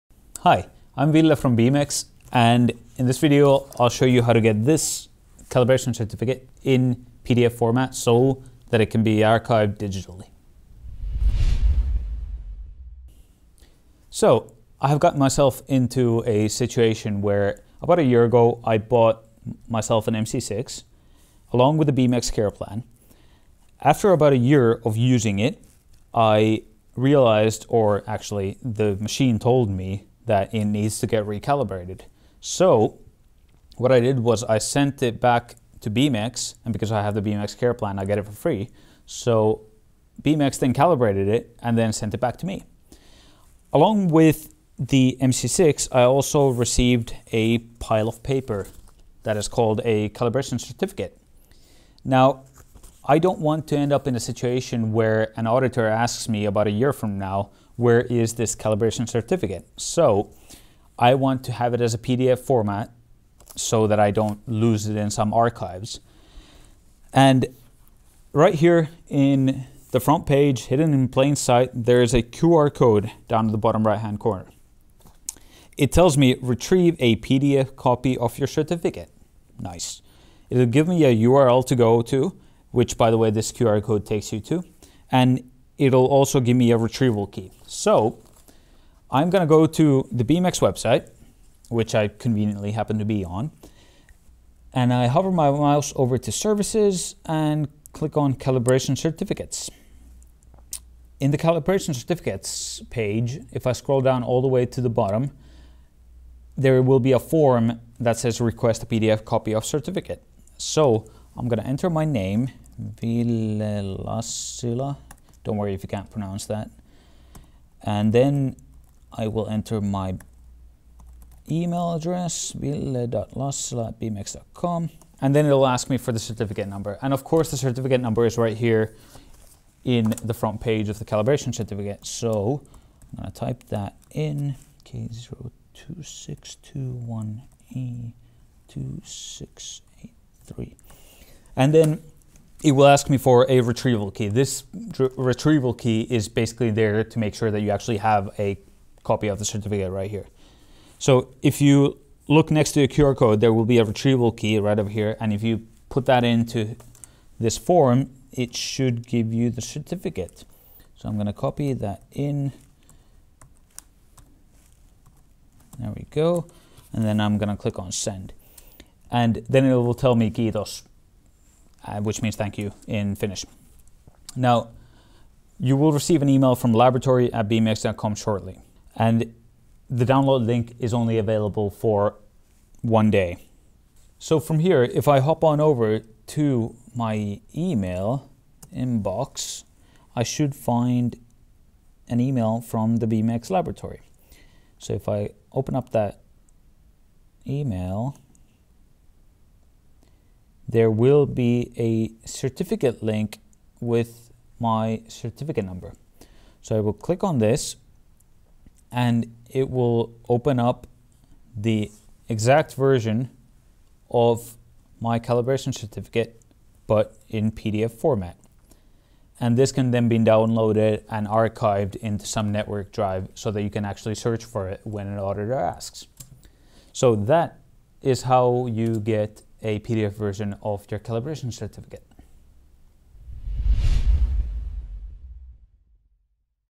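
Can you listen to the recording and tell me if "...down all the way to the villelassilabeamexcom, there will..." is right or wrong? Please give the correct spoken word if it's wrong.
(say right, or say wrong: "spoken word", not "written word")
wrong: "bottom", not "villelassilabeamexcom".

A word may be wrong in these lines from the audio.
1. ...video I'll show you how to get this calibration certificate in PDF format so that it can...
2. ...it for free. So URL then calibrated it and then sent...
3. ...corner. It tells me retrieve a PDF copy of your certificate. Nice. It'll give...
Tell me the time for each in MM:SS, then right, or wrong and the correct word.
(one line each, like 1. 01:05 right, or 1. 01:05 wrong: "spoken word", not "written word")
1. 00:03 right
2. 00:38 wrong: "Beamex", not "URL"
3. 01:14 right.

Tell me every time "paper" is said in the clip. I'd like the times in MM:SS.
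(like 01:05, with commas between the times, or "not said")
00:48.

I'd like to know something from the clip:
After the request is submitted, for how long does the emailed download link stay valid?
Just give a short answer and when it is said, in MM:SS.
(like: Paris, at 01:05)
One day, at 03:02.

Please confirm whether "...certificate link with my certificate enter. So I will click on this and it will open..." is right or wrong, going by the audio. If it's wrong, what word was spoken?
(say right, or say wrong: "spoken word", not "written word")
wrong: "number", not "enter".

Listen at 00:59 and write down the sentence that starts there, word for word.
So I want to have it as a PDF format so that I don't lose it in some archives.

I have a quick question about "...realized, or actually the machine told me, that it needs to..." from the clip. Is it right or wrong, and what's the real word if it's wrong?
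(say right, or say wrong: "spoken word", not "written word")
right.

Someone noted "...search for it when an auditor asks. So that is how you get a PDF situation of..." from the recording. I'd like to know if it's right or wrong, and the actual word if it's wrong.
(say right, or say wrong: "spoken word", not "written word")
wrong: "version", not "situation".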